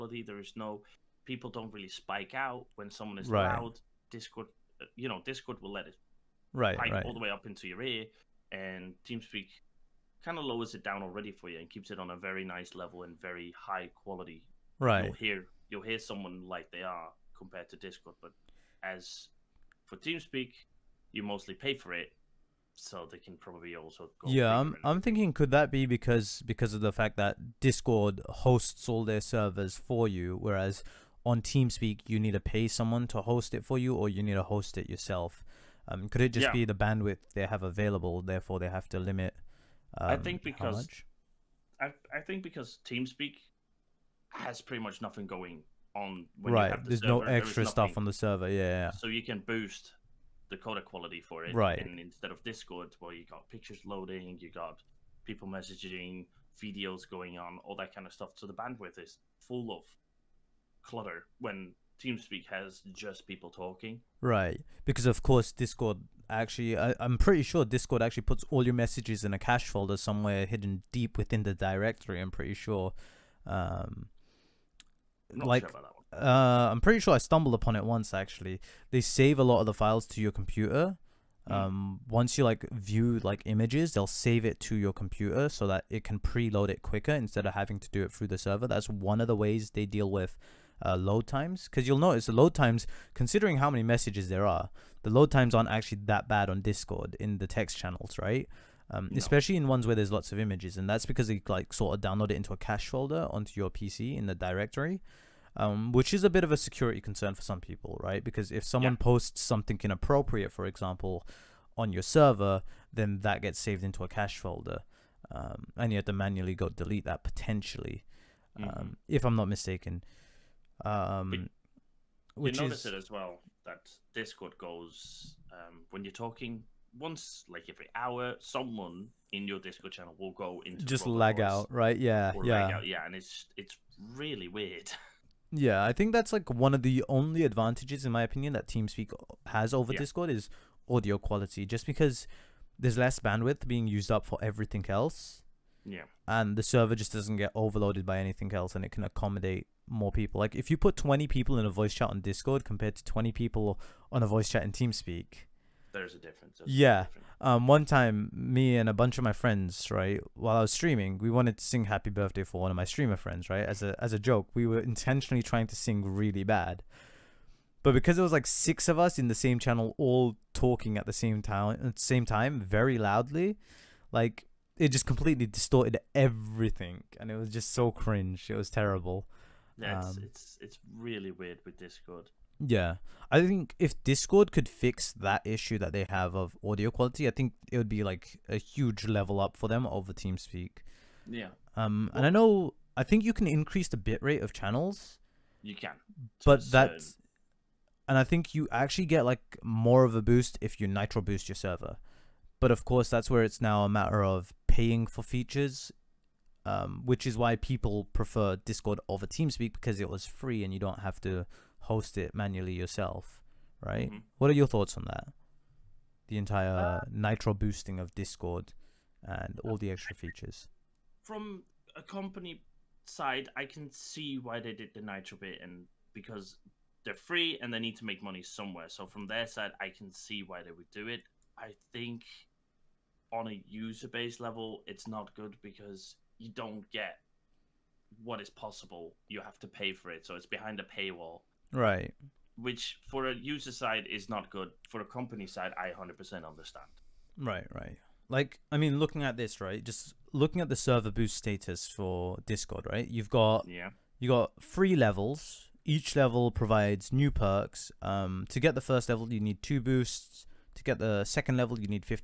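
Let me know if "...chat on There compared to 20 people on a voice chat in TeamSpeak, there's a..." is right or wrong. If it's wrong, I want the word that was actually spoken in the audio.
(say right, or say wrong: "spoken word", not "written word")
wrong: "Discord", not "There".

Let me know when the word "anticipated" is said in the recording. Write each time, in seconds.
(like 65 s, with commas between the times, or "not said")
not said.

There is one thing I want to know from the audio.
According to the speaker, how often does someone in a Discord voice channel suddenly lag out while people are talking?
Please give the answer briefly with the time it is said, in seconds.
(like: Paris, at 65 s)
Every hour, at 127 s.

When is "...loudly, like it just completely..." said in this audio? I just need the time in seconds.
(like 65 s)
172 s.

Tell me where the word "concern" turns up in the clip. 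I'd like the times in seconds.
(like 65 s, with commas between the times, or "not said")
107 s.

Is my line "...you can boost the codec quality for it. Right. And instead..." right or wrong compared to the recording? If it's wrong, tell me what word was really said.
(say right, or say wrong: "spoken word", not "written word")
right.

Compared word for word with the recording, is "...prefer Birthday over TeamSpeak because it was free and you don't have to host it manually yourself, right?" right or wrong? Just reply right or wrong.
wrong.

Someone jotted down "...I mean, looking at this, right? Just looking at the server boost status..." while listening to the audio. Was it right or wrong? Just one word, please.
right.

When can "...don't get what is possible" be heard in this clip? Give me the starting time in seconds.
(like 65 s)
236 s.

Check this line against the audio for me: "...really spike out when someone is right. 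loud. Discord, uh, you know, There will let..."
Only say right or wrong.
wrong.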